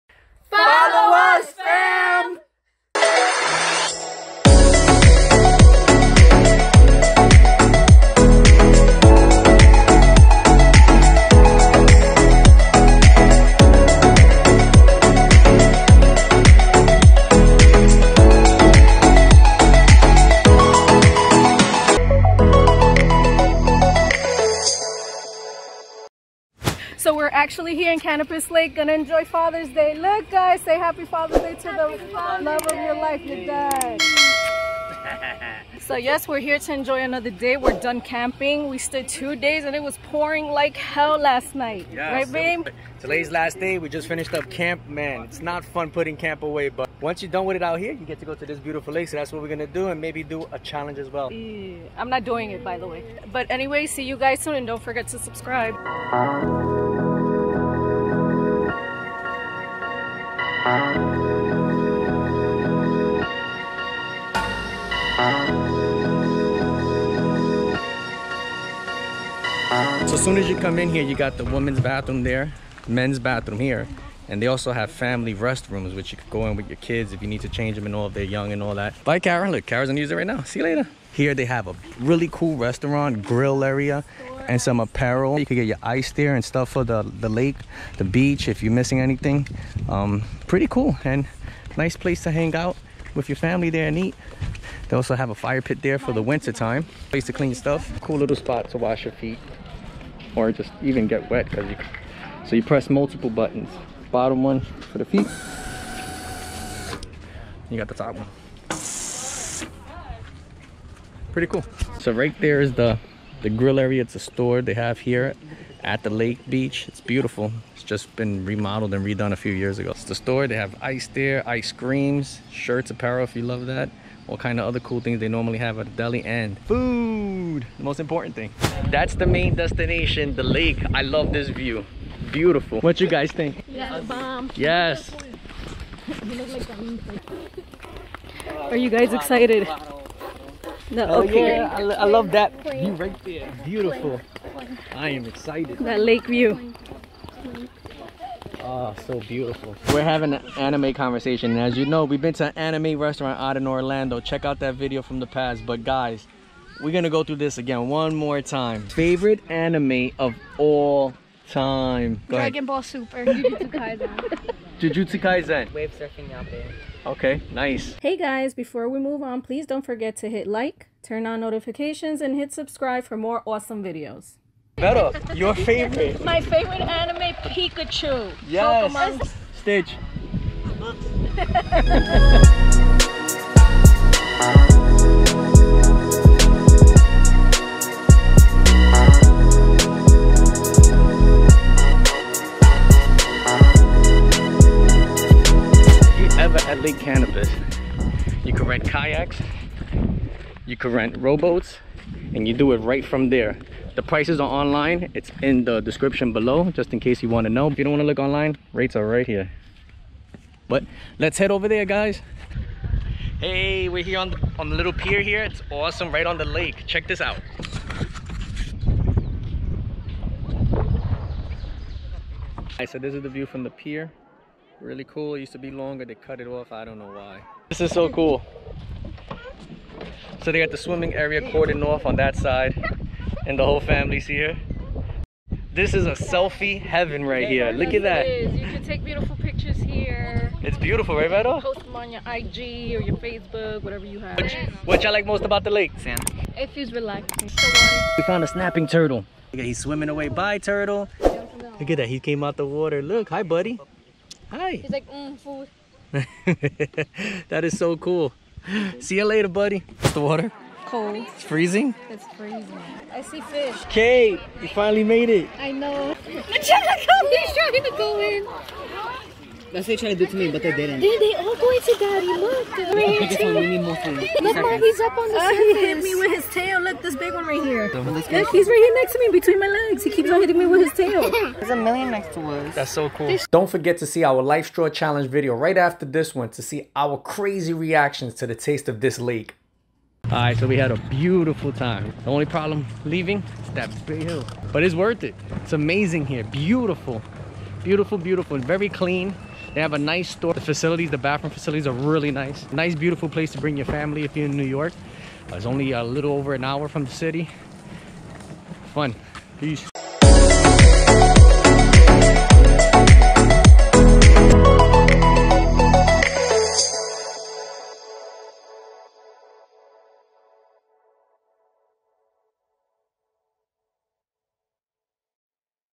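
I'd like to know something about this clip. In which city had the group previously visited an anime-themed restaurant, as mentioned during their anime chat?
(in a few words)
Orlando.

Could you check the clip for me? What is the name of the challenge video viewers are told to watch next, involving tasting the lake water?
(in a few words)
LifeStraw Challenge.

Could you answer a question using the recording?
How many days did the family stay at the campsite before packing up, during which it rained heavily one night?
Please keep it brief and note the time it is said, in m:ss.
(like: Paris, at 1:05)
2, at 0:39.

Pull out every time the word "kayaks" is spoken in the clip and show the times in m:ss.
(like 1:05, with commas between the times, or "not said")
3:18.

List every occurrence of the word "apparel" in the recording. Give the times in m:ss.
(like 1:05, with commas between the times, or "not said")
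1:24, 2:02.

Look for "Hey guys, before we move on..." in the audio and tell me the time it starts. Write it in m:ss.
2:48.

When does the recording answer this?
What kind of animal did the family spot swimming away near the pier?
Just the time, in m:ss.
4:08.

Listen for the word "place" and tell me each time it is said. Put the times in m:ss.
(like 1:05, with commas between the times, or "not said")
1:31, 1:37, 5:03.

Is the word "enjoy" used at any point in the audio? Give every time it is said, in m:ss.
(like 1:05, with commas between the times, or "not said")
0:28, 0:36.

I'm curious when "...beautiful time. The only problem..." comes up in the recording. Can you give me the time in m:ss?
4:51.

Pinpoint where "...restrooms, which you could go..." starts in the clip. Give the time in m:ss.
1:15.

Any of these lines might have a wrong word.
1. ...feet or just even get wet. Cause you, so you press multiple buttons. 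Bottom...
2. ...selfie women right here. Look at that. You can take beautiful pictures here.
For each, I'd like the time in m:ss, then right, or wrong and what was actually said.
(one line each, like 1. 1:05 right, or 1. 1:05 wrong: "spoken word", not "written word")
1. 1:39 right
2. 3:56 wrong: "heaven", not "women".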